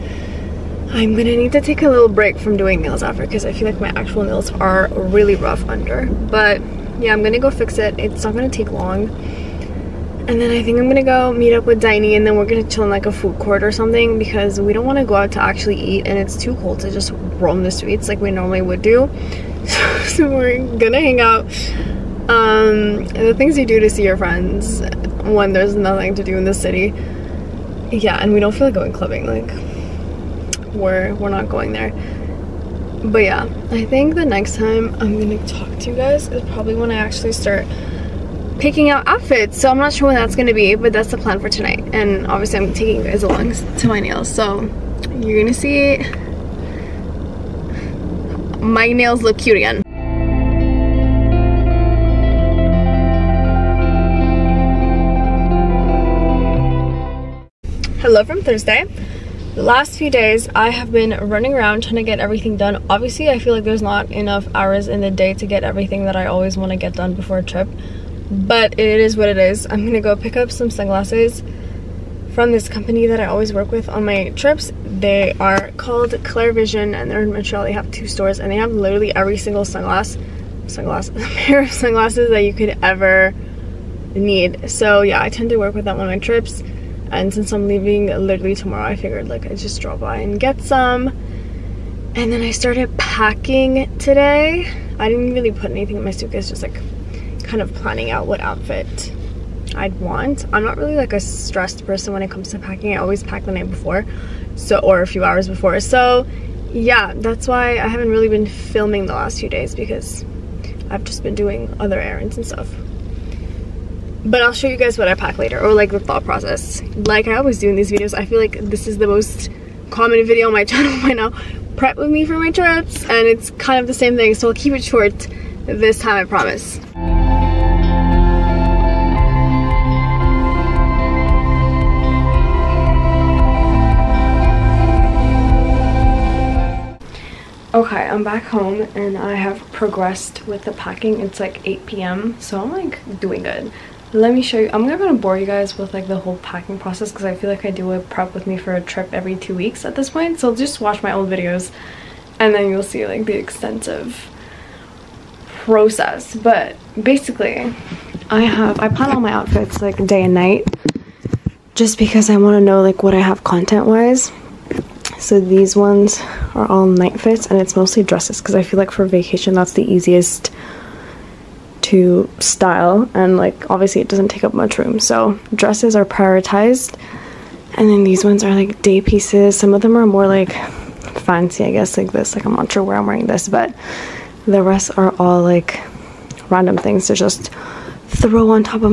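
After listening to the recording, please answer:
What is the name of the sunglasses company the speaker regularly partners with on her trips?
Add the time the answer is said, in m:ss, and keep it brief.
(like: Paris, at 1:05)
Klar Vision, at 1:16.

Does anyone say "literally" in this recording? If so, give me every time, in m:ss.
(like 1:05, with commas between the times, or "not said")
1:18, 1:28.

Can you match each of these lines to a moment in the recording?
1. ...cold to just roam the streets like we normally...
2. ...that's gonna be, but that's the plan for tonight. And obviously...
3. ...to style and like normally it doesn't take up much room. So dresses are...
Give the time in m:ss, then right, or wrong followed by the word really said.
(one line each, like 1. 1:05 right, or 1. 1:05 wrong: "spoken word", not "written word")
1. 0:16 right
2. 0:40 right
3. 2:51 wrong: "obviously", not "normally".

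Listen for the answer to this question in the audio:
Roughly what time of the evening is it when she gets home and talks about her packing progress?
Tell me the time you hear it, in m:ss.
2:21.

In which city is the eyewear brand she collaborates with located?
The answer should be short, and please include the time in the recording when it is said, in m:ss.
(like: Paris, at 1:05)
Montreal, at 1:17.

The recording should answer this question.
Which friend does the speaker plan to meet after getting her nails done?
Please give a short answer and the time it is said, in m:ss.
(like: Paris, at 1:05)
Diney, at 0:11.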